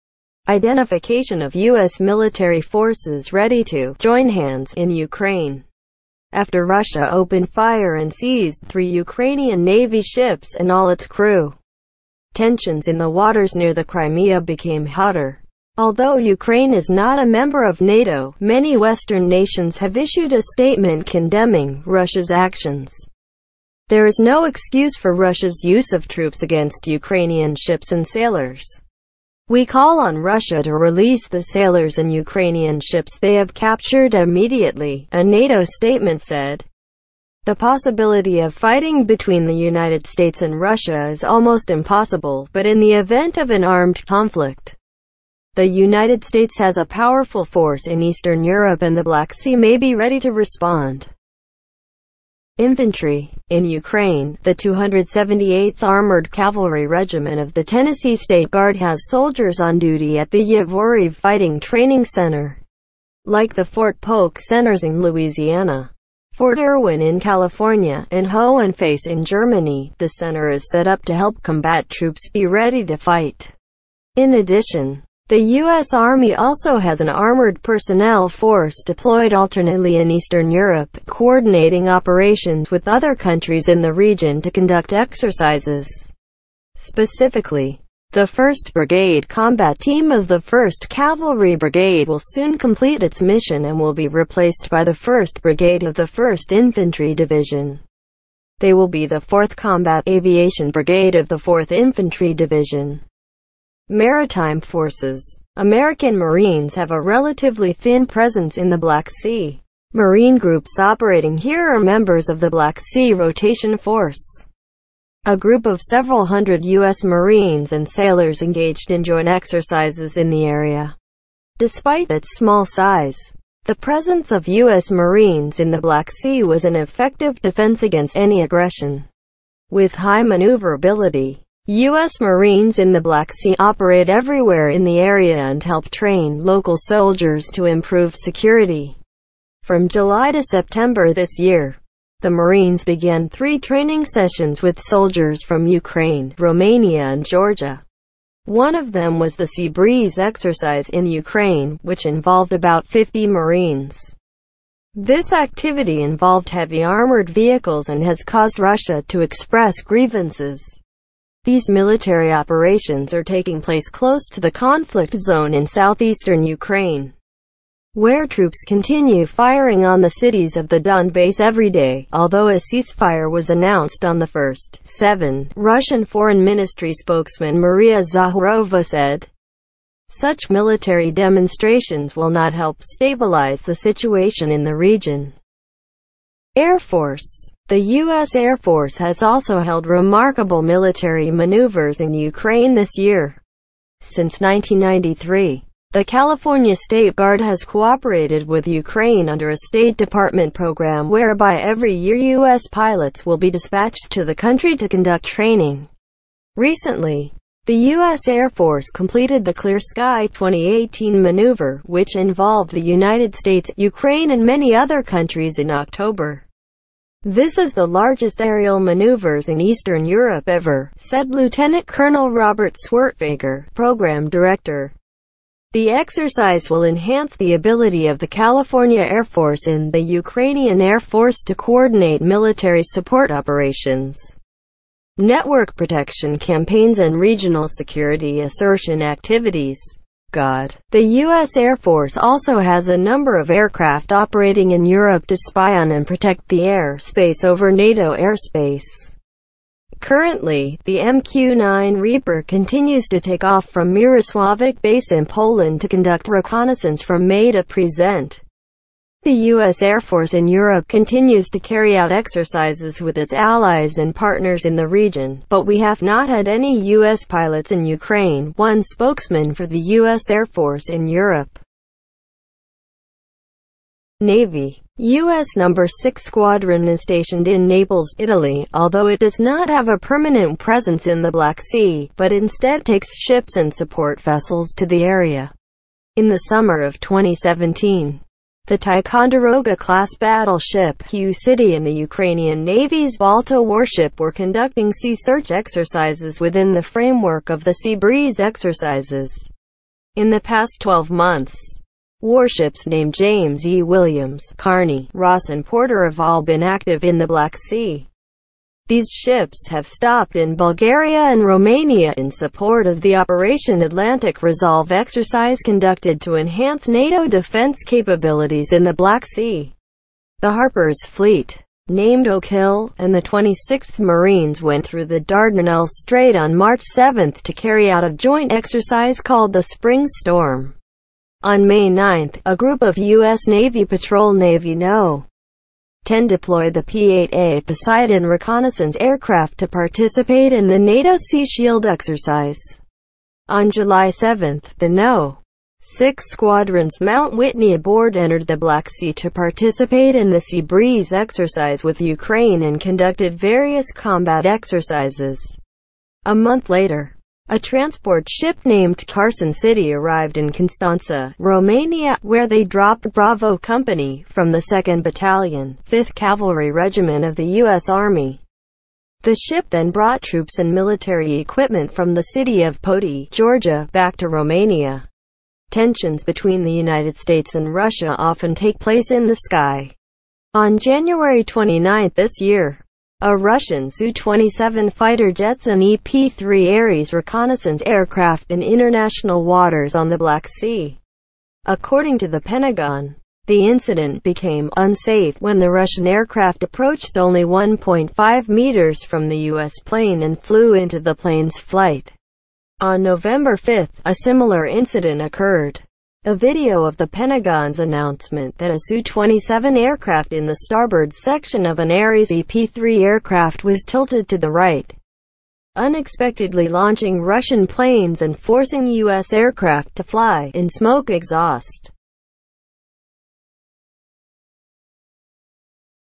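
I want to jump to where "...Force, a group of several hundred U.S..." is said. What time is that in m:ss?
1:53.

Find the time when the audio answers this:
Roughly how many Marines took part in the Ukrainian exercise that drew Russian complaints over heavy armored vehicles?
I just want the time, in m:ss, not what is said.
2:32.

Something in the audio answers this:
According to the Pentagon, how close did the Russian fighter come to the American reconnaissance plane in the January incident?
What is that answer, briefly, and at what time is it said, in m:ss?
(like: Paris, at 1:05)
1.5 meters, at 6:37.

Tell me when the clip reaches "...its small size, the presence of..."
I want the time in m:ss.
2:02.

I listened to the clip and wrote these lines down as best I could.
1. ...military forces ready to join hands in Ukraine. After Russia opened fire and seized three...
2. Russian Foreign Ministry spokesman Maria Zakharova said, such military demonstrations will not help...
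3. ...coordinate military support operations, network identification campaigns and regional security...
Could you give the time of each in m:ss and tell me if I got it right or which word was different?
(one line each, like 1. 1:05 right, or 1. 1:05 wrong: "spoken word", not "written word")
1. 0:02 right
2. 2:55 right
3. 3:51 wrong: "protection", not "identification".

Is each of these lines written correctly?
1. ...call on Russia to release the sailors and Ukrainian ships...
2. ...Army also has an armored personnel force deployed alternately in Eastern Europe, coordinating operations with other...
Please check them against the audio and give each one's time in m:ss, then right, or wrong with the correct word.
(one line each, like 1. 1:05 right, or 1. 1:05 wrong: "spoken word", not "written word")
1. 0:29 right
2. 1:15 right.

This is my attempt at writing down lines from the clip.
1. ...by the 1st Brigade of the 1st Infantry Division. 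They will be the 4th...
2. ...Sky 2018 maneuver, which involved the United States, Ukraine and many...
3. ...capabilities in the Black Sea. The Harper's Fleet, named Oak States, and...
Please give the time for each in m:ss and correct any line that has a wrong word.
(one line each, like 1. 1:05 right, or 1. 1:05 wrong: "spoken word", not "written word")
1. 1:34 right
2. 3:29 right
3. 5:17 wrong: "Hill", not "States".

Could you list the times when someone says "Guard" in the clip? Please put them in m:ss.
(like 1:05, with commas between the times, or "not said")
0:58, 3:17.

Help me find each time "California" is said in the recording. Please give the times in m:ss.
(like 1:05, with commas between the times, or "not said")
1:07, 3:16, 3:48.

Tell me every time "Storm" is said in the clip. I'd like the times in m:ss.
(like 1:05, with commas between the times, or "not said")
5:30.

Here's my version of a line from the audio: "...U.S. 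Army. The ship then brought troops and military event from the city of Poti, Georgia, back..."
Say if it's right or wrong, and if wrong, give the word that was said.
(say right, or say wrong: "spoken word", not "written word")
wrong: "equipment", not "event".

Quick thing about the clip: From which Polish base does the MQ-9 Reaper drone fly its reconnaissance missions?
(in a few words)
Mirosławiec.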